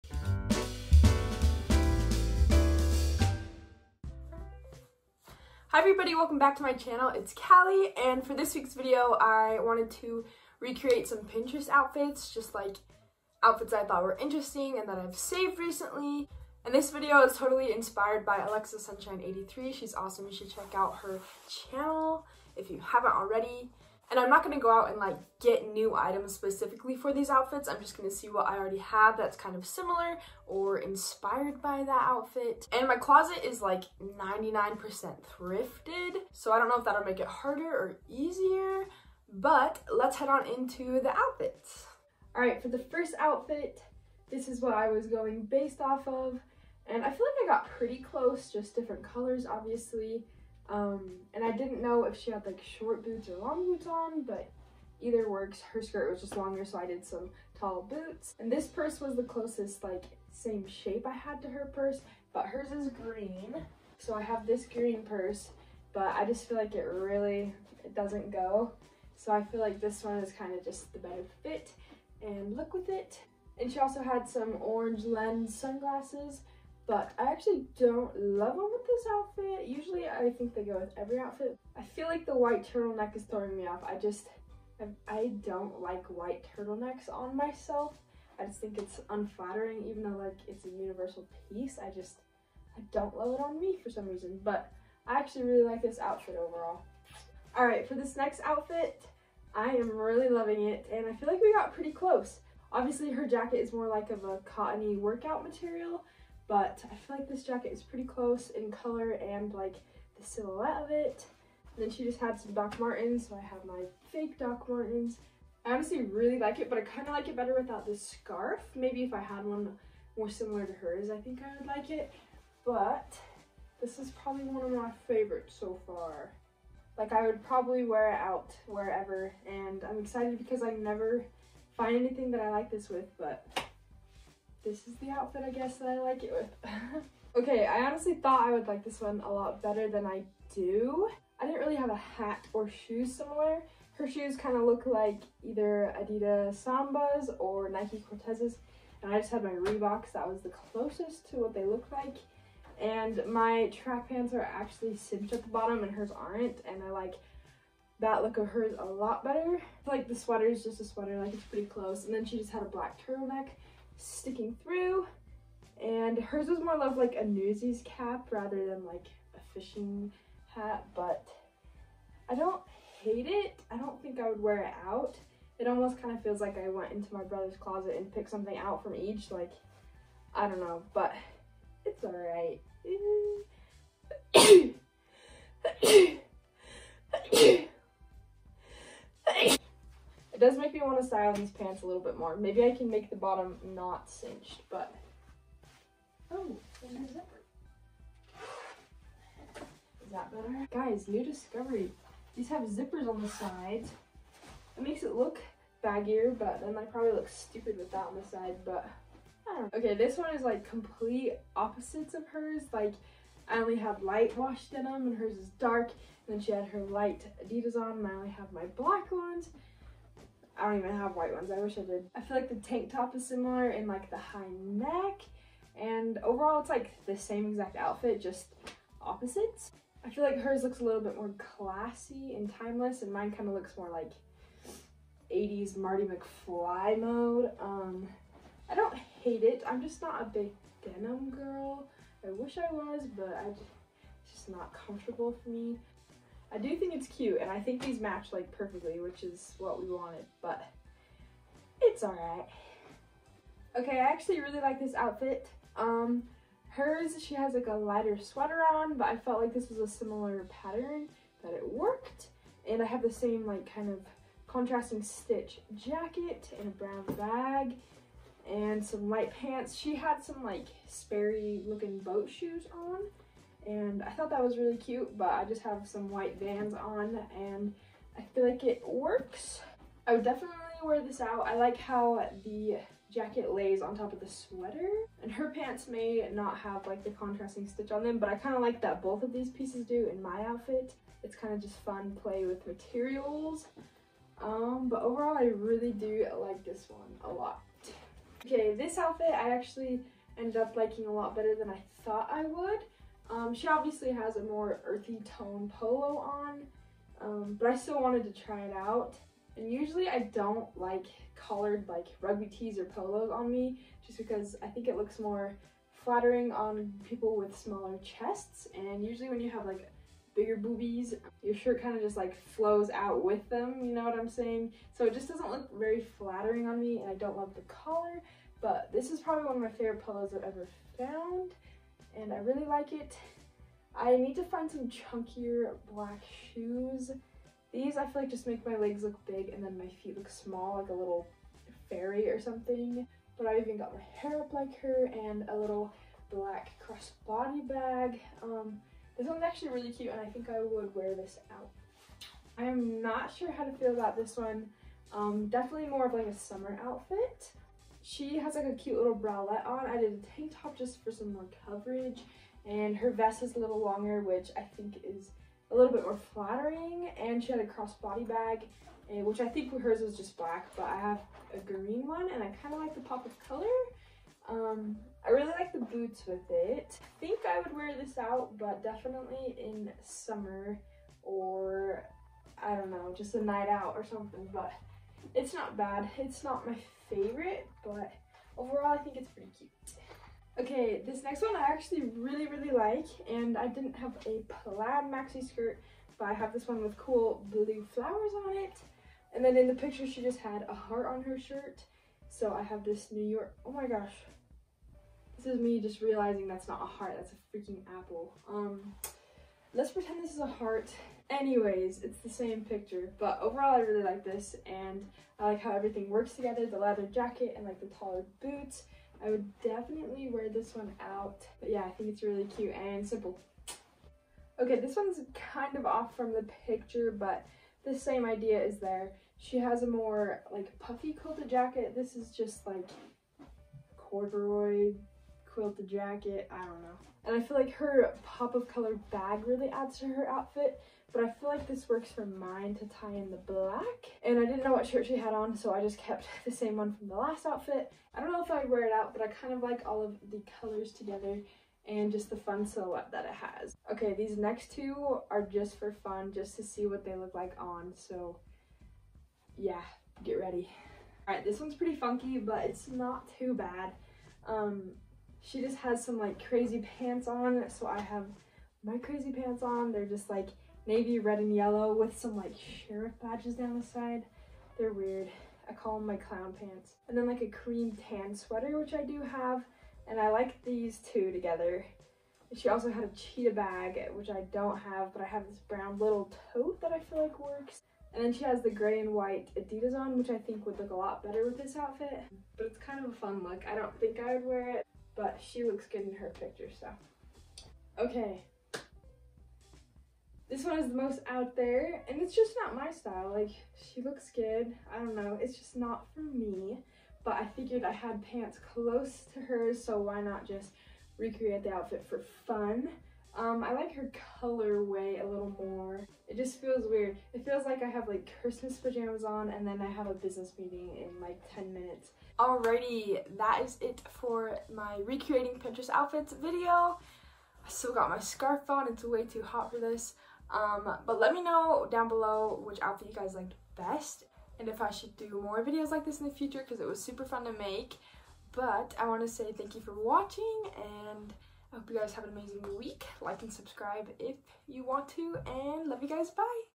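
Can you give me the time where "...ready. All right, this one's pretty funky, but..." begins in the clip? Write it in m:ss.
7:40.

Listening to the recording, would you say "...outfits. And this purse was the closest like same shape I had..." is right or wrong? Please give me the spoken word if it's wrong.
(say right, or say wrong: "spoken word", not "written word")
wrong: "boots", not "outfits".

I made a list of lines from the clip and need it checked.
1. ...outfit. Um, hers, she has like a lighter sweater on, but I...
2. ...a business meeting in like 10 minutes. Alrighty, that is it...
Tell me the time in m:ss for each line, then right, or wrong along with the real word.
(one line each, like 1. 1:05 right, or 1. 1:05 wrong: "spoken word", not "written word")
1. 4:14 right
2. 8:40 right.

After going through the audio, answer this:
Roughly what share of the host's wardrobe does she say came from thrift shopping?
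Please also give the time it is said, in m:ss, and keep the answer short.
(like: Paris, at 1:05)
99%, at 0:34.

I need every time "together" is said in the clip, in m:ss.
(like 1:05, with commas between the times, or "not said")
6:56, 7:30, 8:01.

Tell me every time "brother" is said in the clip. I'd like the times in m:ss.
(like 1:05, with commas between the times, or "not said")
2:57.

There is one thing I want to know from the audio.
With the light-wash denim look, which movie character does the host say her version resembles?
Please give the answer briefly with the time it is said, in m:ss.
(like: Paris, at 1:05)
Marty McFly, at 3:55.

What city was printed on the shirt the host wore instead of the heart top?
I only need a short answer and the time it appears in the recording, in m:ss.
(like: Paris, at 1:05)
New York, at 6:43.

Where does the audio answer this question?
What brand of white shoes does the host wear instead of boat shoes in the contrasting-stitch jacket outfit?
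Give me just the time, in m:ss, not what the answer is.
4:36.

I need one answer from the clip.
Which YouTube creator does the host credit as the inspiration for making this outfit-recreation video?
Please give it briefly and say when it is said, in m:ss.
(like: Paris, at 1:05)
Alexa Sunshine 83, at 0:18.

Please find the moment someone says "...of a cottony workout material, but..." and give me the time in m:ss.
1:44.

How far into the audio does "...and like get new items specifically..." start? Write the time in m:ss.
0:24.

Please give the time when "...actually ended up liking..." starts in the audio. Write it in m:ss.
4:59.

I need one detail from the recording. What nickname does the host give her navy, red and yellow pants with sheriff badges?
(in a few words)
Clown pants.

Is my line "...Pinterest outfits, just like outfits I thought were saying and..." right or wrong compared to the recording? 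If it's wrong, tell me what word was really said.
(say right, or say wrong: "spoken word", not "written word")
wrong: "interesting", not "saying".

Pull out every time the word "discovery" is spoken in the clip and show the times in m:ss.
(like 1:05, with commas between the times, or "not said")
3:21.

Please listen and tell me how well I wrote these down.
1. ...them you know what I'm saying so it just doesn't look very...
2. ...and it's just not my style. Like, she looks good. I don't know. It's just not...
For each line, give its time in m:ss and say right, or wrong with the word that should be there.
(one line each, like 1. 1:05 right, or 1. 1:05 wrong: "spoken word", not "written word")
1. 5:23 right
2. 8:22 right.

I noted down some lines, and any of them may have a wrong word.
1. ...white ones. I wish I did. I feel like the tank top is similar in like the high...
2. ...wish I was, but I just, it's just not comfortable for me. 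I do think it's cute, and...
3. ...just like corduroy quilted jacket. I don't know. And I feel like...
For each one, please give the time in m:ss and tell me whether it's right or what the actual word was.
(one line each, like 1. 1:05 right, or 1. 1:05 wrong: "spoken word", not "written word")
1. 3:41 right
2. 4:02 right
3. 7:12 right.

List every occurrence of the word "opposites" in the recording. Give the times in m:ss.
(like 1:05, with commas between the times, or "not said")
3:31, 3:49.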